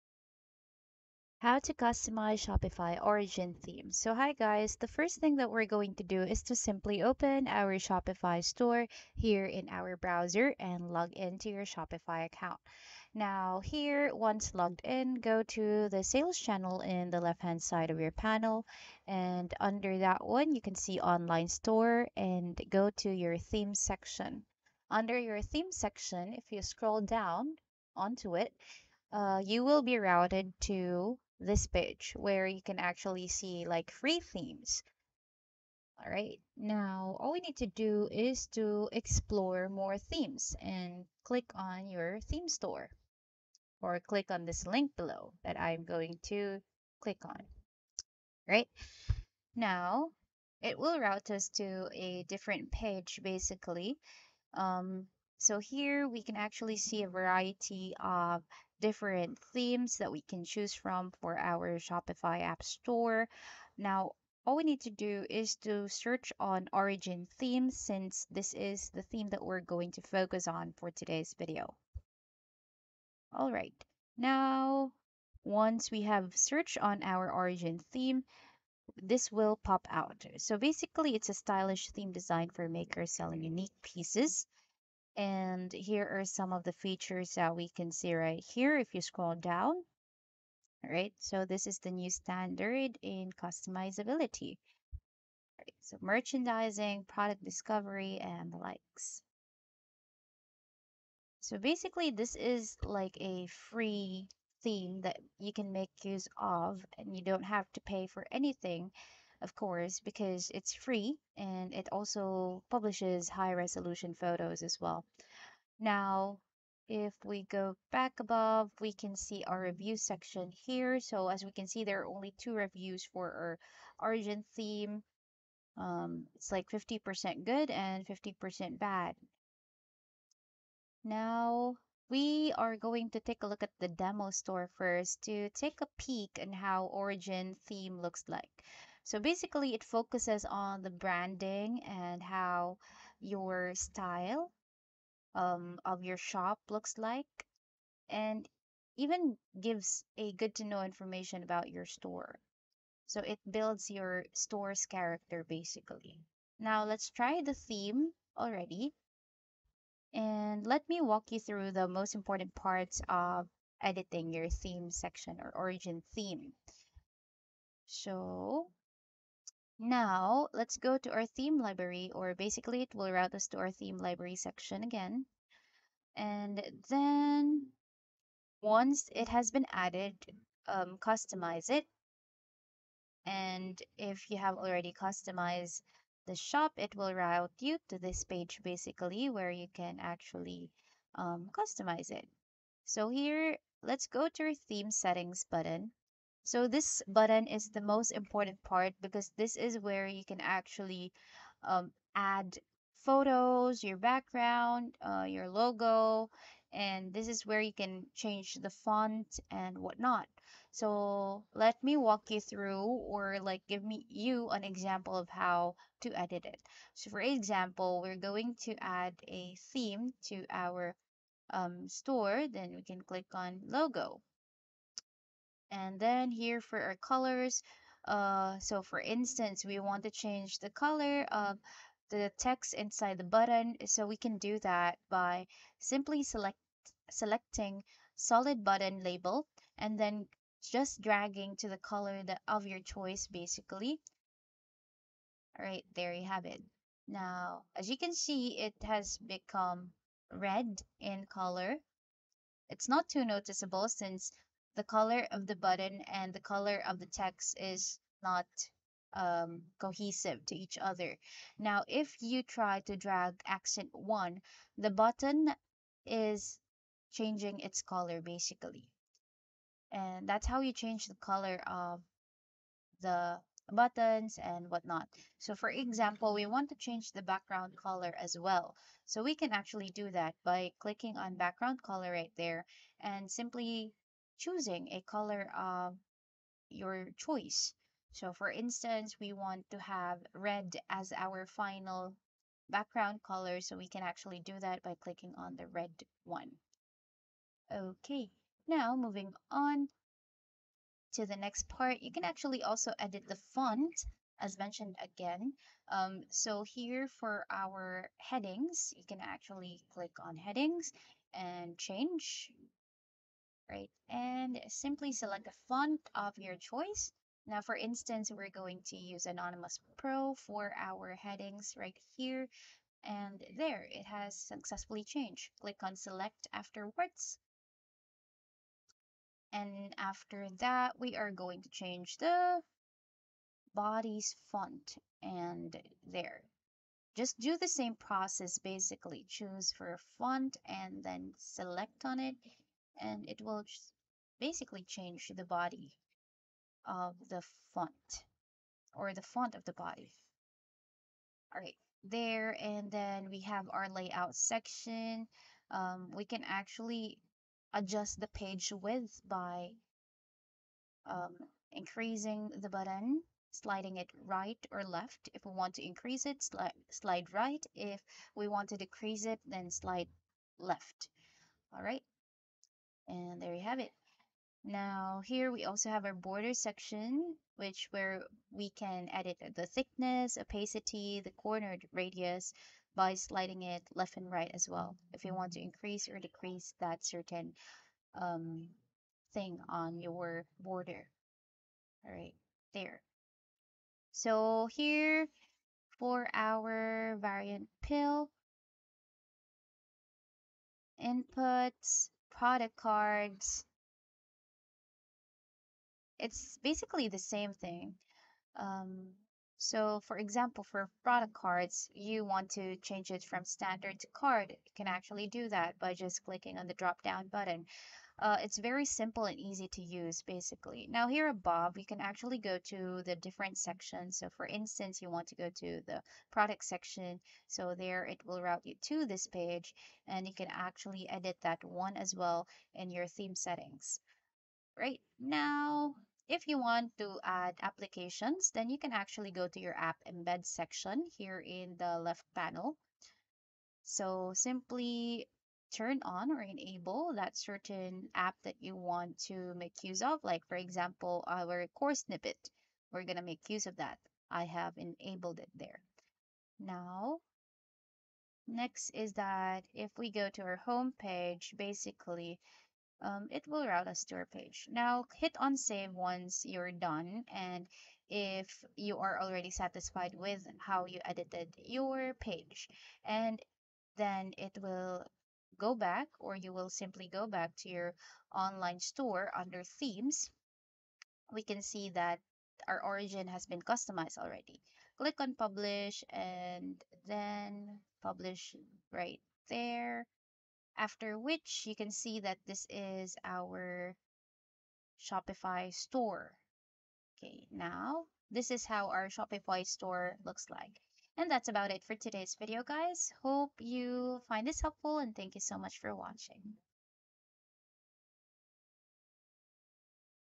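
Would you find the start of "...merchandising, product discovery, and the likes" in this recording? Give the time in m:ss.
1:36.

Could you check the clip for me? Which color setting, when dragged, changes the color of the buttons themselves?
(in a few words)
Accent 1.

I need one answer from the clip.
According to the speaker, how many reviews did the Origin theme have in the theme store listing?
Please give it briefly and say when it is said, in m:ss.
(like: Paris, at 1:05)
2, at 2:02.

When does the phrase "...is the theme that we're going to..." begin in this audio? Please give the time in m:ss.
1:08.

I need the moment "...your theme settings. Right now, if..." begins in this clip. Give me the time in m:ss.
7:12.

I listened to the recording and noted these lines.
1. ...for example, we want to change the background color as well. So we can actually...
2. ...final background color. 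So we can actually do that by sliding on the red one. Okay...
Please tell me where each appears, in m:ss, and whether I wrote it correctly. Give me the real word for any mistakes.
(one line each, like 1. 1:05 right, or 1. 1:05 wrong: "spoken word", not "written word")
1. 4:35 right
2. 4:51 wrong: "clicking", not "sliding".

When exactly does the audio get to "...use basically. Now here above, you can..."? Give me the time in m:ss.
6:59.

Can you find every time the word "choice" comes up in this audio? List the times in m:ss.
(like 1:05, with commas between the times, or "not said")
4:02, 4:47, 5:16.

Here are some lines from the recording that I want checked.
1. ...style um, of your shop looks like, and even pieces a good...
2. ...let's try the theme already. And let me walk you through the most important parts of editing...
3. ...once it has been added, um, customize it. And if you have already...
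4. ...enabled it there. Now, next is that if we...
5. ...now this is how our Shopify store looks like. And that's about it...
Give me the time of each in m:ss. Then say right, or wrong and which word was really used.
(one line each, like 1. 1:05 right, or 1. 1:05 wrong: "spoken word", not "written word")
1. 2:23 wrong: "gives", not "pieces"
2. 2:36 right
3. 2:58 right
4. 7:34 right
5. 8:17 right.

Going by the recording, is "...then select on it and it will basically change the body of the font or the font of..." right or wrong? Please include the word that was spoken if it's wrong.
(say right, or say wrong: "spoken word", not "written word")
right.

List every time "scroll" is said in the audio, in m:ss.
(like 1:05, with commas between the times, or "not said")
0:26, 1:29.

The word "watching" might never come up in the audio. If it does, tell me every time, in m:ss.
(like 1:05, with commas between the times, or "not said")
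8:25.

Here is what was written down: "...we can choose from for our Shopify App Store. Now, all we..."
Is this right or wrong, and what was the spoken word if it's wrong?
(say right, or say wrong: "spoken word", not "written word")
right.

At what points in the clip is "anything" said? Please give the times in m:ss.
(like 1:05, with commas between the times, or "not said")
1:48.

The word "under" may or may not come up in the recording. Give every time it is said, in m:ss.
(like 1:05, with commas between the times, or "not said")
0:19, 0:24, 7:59.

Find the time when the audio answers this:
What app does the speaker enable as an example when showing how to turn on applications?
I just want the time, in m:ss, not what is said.
7:31.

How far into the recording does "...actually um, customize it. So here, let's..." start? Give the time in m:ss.
3:09.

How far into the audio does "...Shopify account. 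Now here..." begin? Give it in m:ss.
0:11.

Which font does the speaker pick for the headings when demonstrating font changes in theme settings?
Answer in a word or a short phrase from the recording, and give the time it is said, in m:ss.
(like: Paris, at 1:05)
Anonymous Pro, at 5:19.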